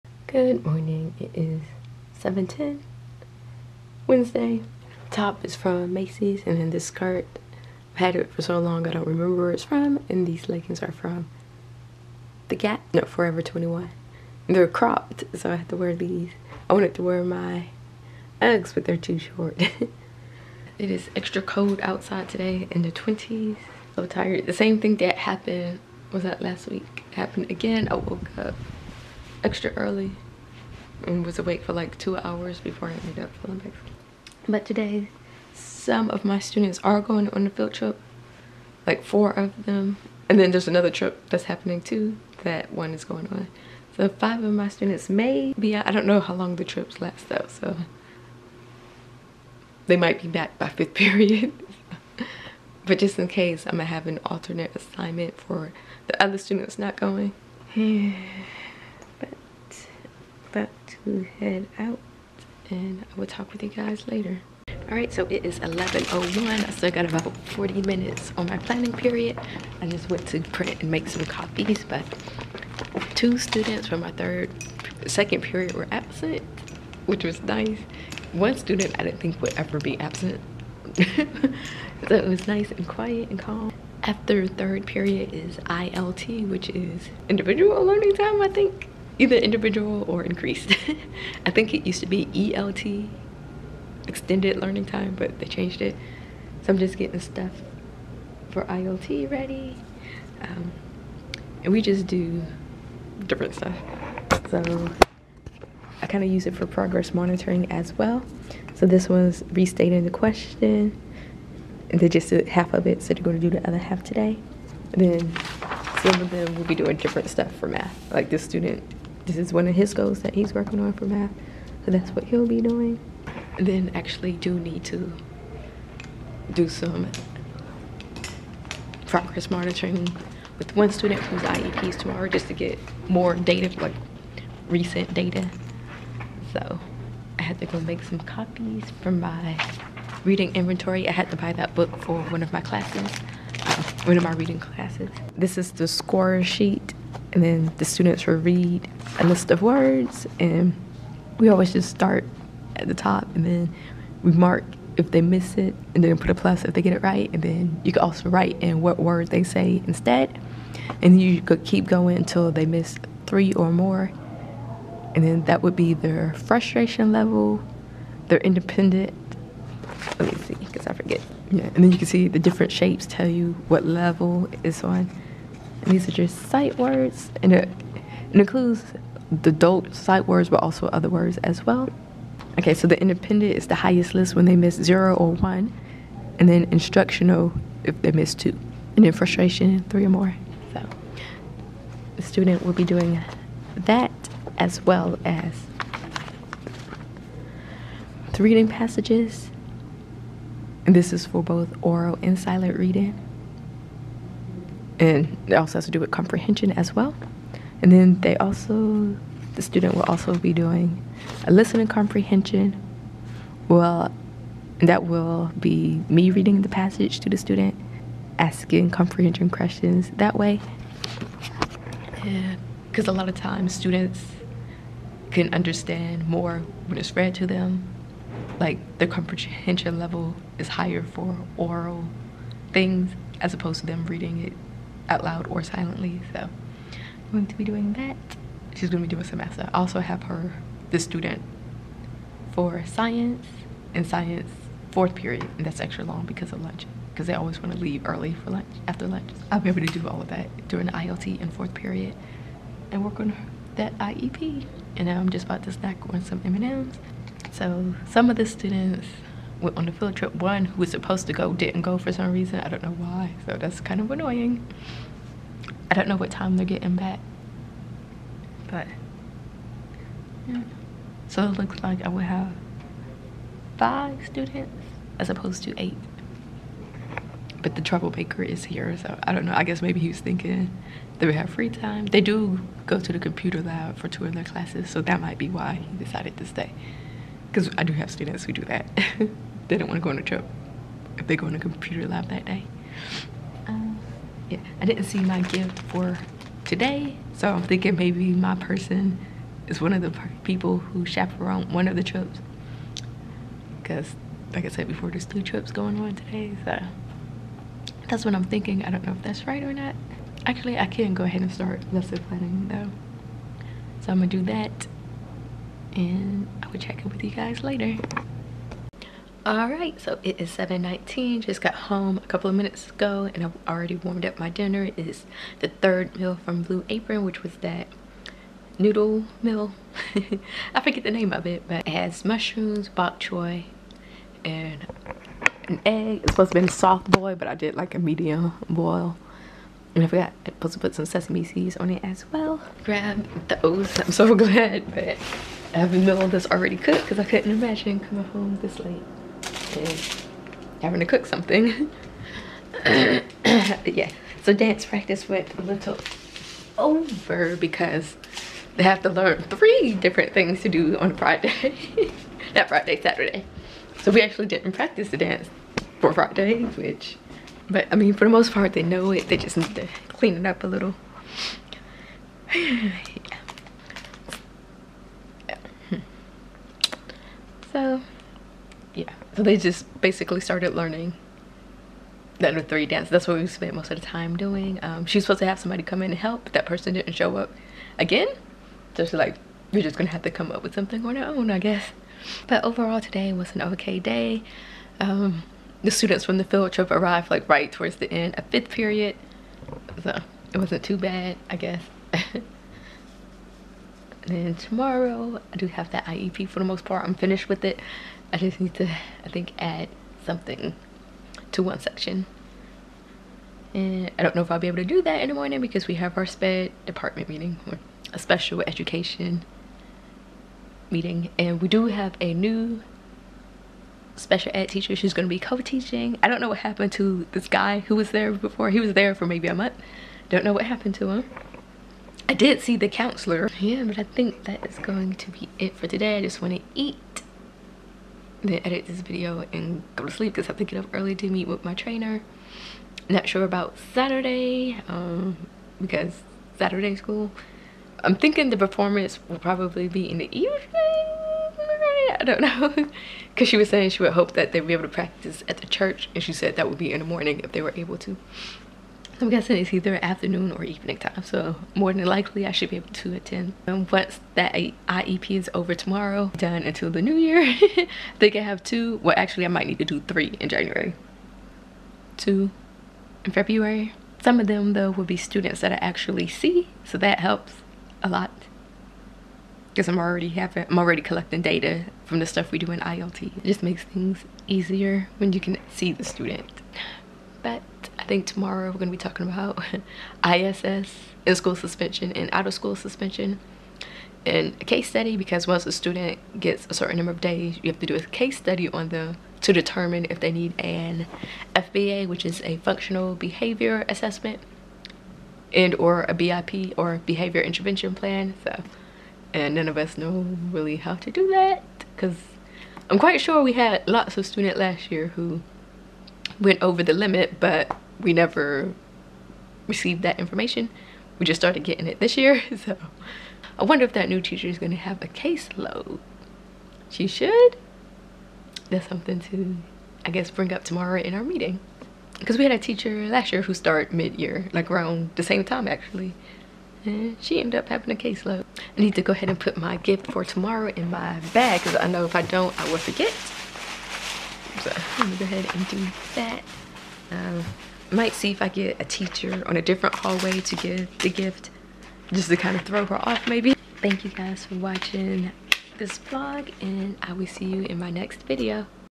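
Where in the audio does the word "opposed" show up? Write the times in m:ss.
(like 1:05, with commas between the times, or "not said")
3:53, 4:35.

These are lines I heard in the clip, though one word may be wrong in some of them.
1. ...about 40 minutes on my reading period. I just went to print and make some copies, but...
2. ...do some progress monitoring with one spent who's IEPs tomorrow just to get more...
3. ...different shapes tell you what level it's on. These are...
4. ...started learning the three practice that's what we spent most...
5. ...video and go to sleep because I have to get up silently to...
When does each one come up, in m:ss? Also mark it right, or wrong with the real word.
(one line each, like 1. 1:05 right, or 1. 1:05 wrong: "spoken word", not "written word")
1. 1:07 wrong: "planning", not "reading"
2. 2:06 wrong: "student", not "spent"
3. 2:52 right
4. 6:20 wrong: "dance", not "practice"
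5. 7:19 wrong: "early", not "silently".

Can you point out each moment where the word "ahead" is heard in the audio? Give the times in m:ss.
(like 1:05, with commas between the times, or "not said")
5:11, 8:59, 9:05.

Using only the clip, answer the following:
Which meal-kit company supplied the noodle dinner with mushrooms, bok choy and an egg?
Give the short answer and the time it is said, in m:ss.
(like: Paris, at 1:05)
Blue Apron, at 5:26.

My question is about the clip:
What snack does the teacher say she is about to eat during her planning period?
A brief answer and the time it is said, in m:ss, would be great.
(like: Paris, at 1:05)
M&Ms, at 4:16.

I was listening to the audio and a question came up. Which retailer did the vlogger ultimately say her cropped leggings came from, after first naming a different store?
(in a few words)
Forever 21.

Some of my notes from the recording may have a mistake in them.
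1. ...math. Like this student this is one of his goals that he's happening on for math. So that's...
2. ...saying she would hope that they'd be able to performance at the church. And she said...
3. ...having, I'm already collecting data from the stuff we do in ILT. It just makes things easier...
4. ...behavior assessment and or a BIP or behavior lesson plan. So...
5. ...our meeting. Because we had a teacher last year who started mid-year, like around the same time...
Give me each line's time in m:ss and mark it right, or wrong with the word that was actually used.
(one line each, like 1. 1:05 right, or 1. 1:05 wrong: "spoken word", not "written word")
1. 1:57 wrong: "working", not "happening"
2. 7:33 wrong: "practice", not "performance"
3. 8:00 right
4. 8:23 wrong: "intervention", not "lesson"
5. 8:51 right.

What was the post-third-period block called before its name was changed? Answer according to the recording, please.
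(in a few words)
extended learning time.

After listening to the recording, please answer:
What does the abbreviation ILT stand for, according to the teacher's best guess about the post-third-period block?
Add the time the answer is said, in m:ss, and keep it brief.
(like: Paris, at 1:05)
individual learning time, at 1:27.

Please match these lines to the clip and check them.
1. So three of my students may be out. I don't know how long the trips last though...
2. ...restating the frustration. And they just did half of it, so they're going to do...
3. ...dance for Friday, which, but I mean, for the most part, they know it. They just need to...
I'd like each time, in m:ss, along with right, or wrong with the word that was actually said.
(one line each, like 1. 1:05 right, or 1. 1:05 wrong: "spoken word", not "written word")
1. 0:43 wrong: "five", not "three"
2. 1:49 wrong: "question", not "frustration"
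3. 6:05 right.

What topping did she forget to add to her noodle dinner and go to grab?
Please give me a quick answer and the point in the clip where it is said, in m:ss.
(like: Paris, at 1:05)
sesame seeds, at 5:41.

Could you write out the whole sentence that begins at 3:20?
And this is for both oral and silent reading and it also has to do with comprehension as well.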